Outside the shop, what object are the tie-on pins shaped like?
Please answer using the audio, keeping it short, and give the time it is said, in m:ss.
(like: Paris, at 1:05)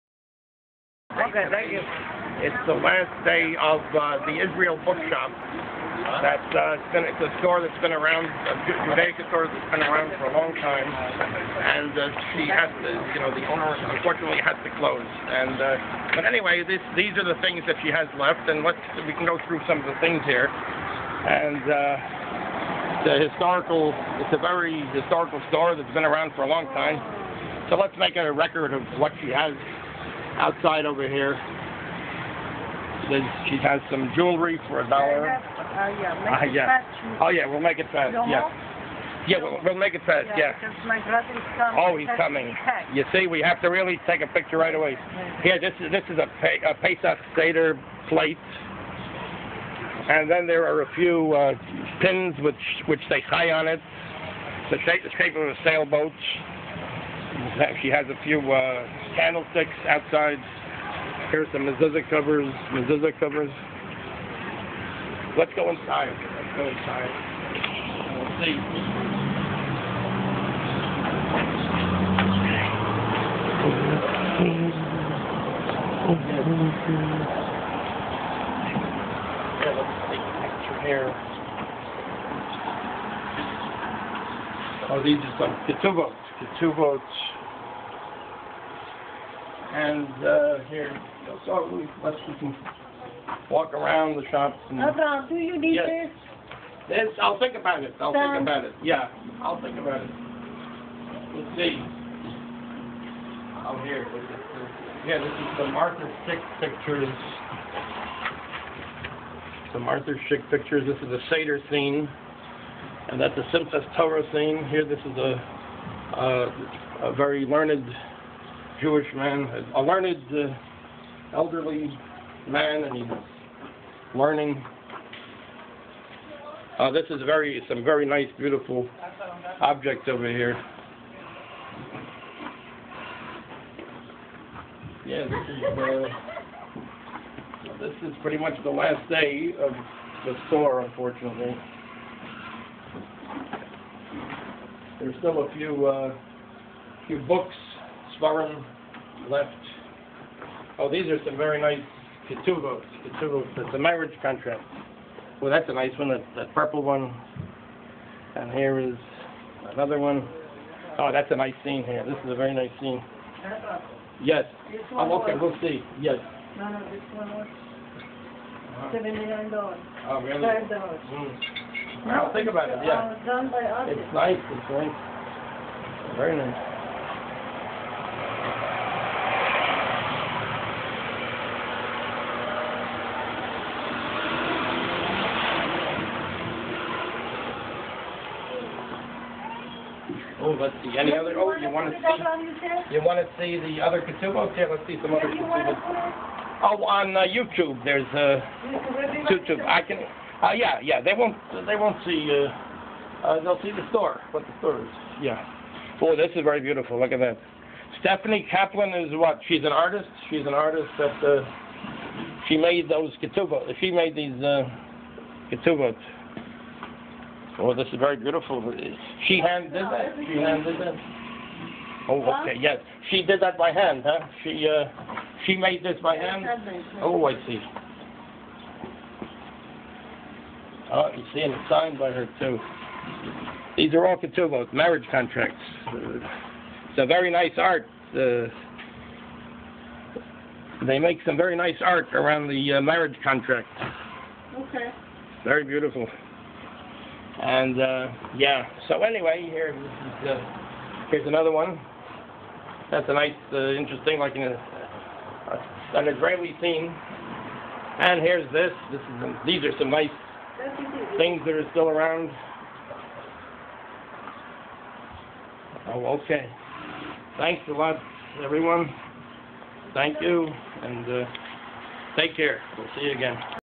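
A sailboat, at 0:55.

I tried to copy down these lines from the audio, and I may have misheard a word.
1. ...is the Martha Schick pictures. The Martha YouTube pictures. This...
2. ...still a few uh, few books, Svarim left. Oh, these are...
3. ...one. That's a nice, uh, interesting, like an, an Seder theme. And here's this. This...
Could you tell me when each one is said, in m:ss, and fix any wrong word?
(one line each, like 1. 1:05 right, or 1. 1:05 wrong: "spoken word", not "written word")
1. 1:45 wrong: "Schick", not "YouTube"
2. 2:25 right
3. 4:11 wrong: "Israeli", not "Seder".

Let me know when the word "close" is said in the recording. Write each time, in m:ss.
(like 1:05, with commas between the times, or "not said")
0:14.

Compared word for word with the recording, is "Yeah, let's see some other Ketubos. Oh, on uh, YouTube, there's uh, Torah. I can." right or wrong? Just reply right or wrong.
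wrong.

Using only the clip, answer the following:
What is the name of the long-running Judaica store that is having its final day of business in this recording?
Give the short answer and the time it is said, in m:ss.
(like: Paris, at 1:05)
Israel Bookshop, at 0:04.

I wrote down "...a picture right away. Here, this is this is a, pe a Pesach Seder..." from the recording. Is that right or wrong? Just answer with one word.
right.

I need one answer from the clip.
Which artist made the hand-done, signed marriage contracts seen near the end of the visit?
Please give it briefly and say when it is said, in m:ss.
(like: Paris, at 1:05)
Stephanie Kaplan, at 3:27.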